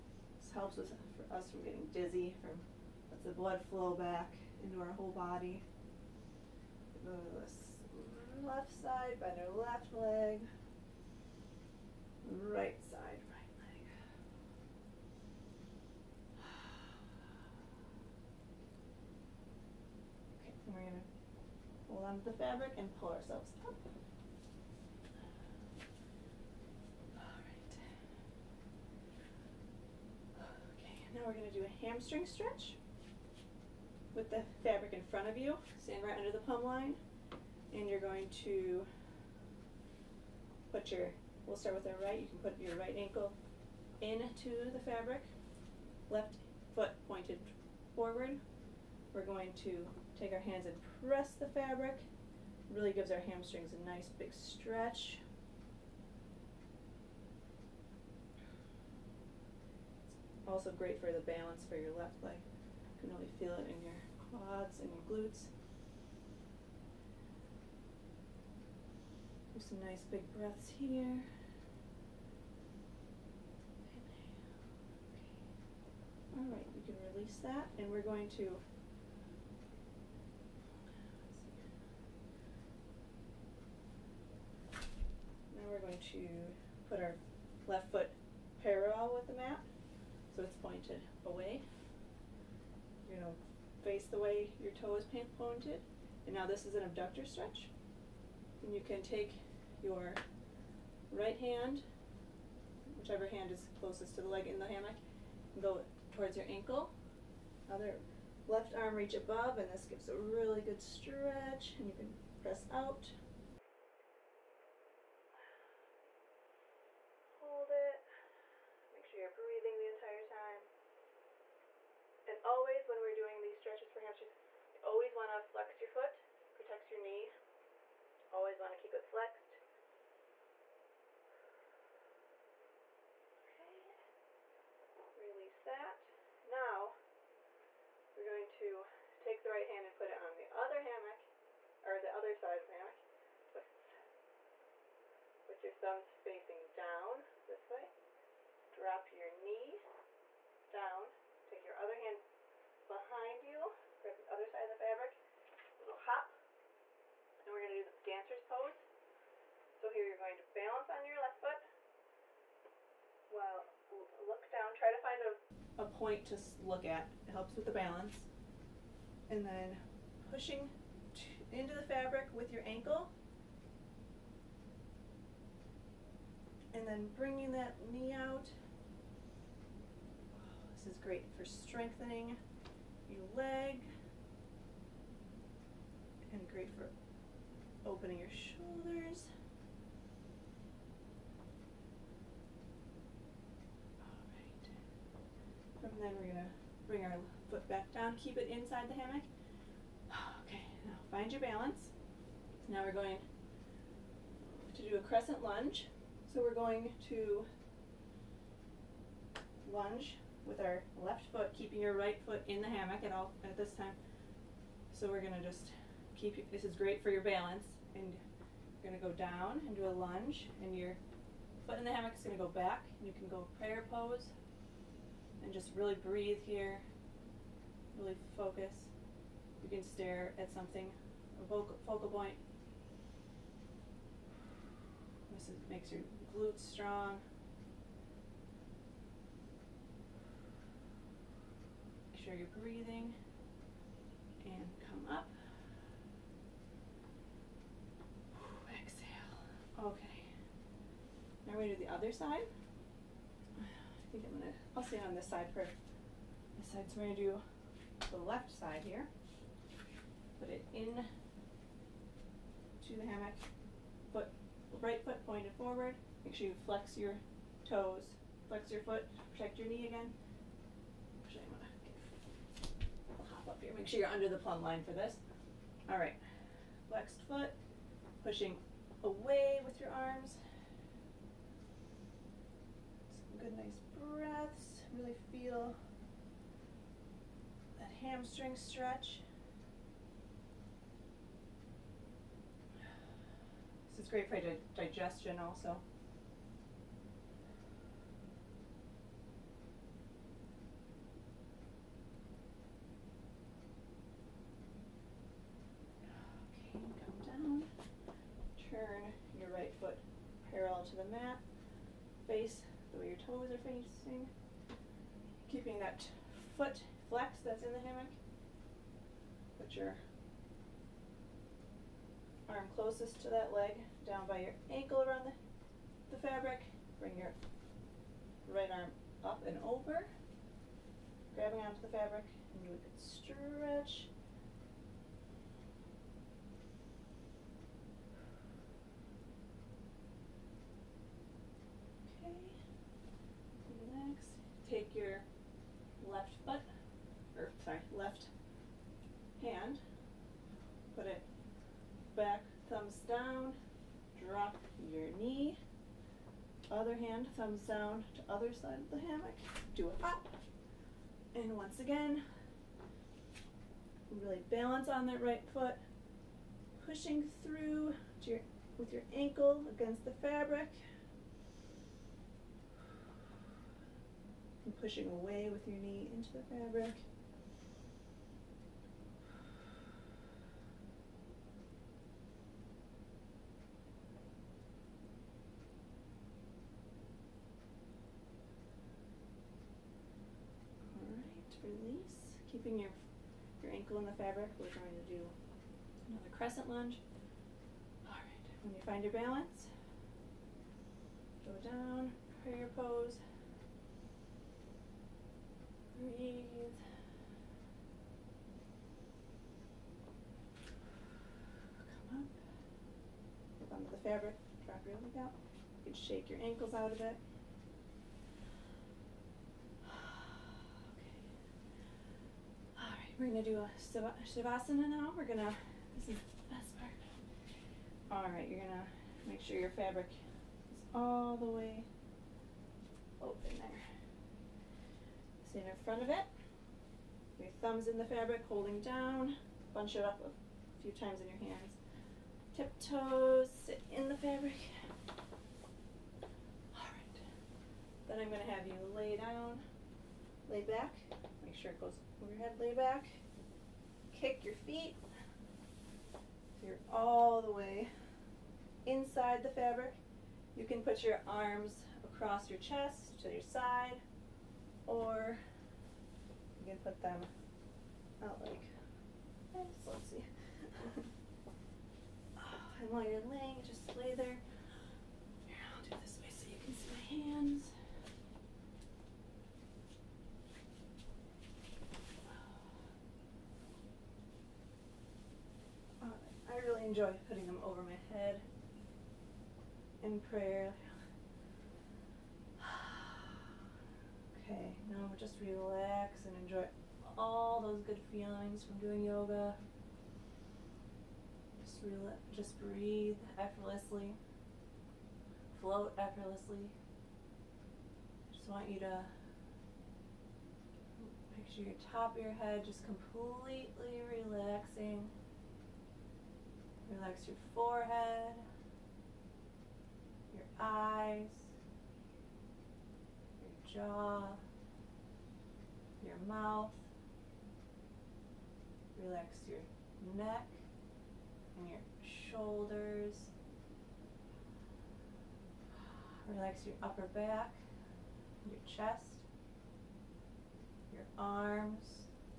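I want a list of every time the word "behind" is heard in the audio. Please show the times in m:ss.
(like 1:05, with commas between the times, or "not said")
2:32.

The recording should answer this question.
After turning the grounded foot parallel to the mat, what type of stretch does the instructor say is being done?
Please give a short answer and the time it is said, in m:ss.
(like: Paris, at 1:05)
Abductor stretch, at 1:36.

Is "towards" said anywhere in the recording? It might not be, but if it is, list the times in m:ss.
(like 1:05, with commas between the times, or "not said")
1:46.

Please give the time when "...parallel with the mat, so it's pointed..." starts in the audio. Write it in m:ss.
1:28.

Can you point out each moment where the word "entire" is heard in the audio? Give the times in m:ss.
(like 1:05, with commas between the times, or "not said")
1:59.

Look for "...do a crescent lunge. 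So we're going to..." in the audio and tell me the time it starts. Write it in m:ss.
3:24.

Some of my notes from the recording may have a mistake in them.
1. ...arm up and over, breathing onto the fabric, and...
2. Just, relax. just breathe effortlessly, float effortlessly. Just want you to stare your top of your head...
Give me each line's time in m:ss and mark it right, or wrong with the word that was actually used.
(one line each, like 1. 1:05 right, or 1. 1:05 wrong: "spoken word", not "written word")
1. 5:28 wrong: "grabbing", not "breathing"
2. 8:21 wrong: "picture", not "stare".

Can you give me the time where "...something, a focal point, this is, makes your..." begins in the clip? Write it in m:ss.
3:50.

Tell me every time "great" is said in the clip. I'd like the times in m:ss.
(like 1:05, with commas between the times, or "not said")
1:00, 3:01, 3:06, 3:36, 4:54.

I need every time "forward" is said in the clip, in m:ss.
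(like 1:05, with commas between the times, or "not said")
0:47, 4:25.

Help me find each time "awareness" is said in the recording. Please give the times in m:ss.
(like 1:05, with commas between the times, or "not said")
not said.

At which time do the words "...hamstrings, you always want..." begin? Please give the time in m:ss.
2:03.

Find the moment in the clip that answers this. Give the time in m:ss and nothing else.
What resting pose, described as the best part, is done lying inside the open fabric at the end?
7:04.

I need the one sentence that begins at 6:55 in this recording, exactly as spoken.
You can shake your ankles out of it.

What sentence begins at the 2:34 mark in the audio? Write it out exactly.
Grab the other side of the fabric.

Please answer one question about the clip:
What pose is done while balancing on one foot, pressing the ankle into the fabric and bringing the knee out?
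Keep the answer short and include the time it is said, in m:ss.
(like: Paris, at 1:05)
Dancer's pose, at 2:38.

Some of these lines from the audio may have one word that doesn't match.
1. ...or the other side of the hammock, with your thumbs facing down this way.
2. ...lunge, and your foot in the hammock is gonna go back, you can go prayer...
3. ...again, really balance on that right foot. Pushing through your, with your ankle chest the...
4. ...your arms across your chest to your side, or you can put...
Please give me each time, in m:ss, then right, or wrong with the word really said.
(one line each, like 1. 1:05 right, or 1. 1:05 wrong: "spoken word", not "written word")
1. 2:21 right
2. 3:39 right
3. 6:01 wrong: "against", not "chest"
4. 7:41 right.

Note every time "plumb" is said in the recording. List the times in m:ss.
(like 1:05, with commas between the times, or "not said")
0:36, 4:34.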